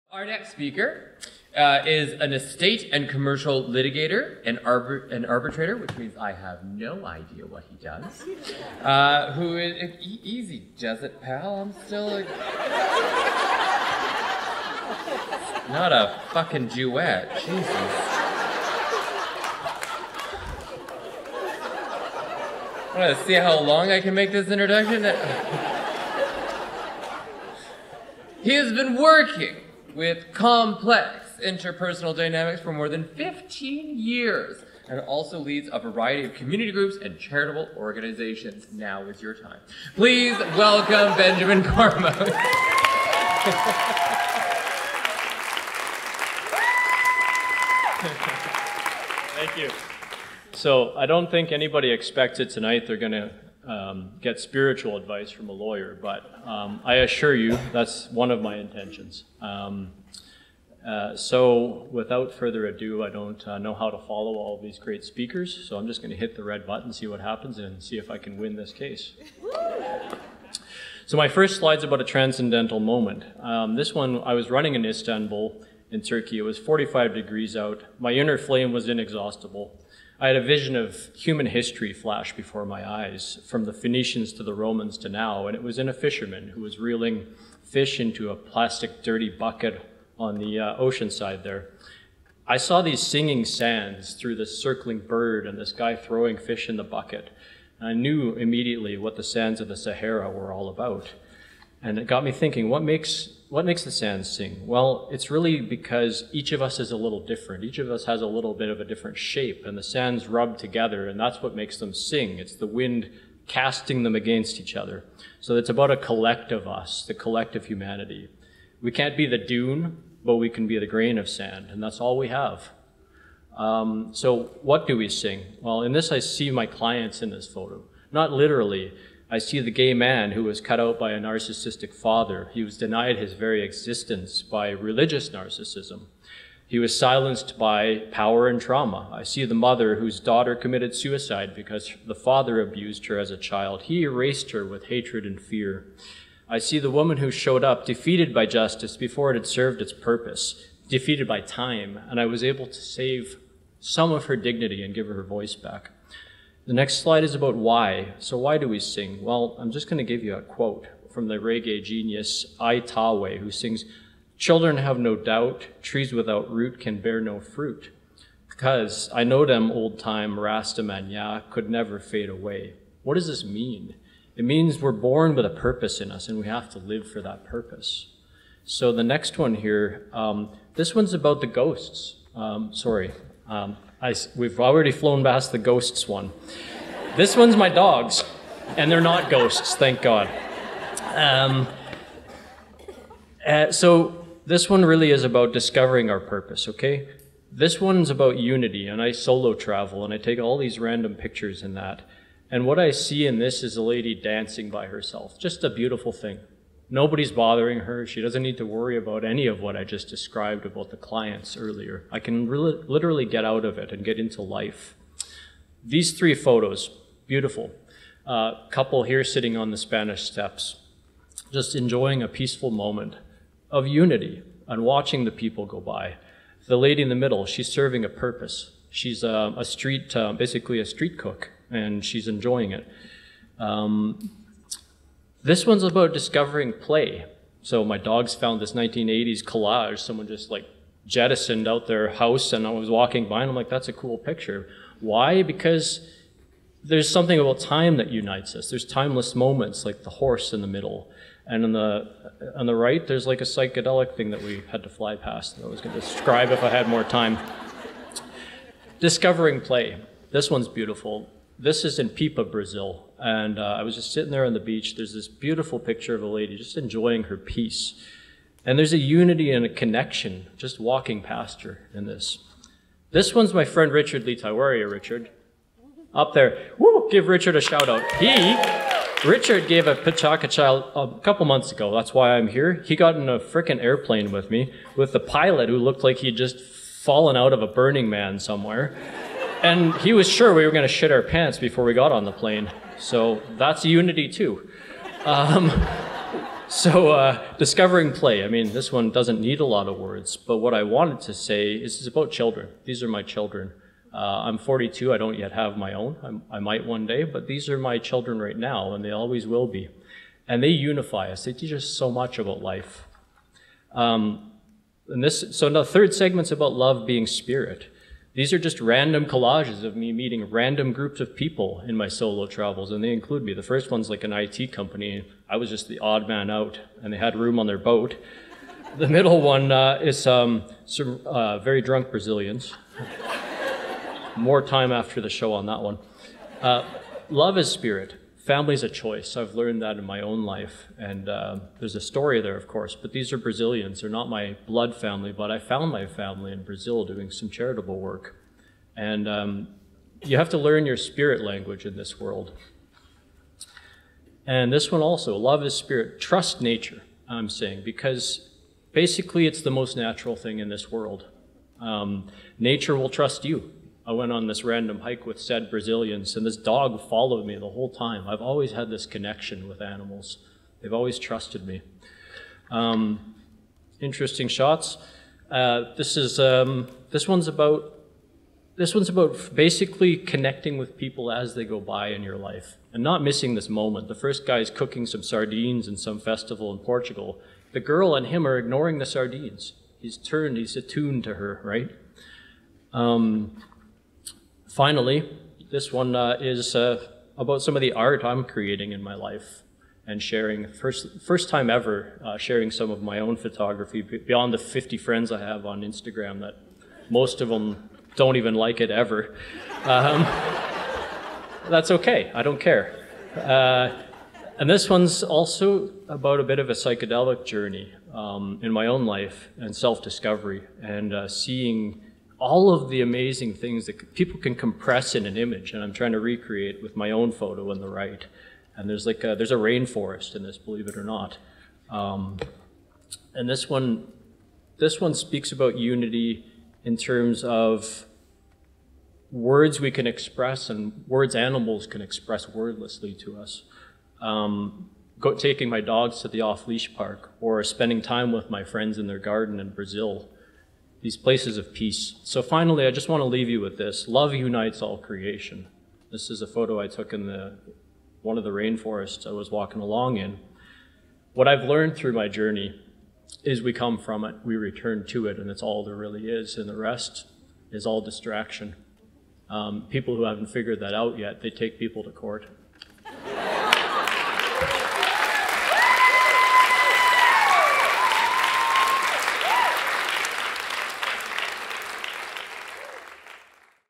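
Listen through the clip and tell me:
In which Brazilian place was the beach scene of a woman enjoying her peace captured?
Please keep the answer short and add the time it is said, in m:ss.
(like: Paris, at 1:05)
Pipa, at 4:22.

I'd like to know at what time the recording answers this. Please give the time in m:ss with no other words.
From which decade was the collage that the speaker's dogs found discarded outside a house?
3:58.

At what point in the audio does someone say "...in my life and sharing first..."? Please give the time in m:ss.
6:38.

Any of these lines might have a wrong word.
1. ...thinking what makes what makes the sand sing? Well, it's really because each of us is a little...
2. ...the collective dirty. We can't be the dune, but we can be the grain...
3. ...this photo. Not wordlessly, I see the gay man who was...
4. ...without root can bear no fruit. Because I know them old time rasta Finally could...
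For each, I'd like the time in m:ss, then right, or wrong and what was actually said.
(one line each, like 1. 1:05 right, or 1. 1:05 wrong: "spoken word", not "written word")
1. 1:42 right
2. 1:57 wrong: "humanity", not "dirty"
3. 2:07 wrong: "literally", not "wordlessly"
4. 2:46 wrong: "Rastamanya", not "Finally".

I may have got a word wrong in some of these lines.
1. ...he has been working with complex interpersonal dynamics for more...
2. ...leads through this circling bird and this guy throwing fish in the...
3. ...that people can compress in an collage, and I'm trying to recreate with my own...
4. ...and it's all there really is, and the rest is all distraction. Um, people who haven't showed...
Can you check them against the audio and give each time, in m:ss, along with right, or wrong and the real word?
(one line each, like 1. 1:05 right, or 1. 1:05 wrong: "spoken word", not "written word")
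1. 0:28 right
2. 1:33 wrong: "sands", not "leads"
3. 7:03 wrong: "image", not "collage"
4. 7:45 wrong: "figured", not "showed".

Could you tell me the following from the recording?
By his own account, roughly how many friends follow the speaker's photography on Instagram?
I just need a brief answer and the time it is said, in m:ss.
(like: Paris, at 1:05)
50, at 6:44.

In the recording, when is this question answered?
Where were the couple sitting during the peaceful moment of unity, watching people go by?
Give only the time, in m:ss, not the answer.
3:39.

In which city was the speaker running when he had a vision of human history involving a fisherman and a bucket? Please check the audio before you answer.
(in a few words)
Istanbul.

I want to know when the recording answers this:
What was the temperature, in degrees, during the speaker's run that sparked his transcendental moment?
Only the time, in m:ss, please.
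1:16.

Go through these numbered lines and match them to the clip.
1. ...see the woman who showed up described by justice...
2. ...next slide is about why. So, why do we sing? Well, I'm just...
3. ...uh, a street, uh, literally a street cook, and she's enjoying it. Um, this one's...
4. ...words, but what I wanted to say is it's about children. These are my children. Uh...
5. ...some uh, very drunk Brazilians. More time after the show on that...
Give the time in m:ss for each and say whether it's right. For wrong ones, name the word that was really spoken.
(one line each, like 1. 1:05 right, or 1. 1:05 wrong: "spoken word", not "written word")
1. 2:26 wrong: "defeated", not "described"
2. 2:36 right
3. 3:49 wrong: "basically", not "literally"
4. 4:59 right
5. 5:30 right.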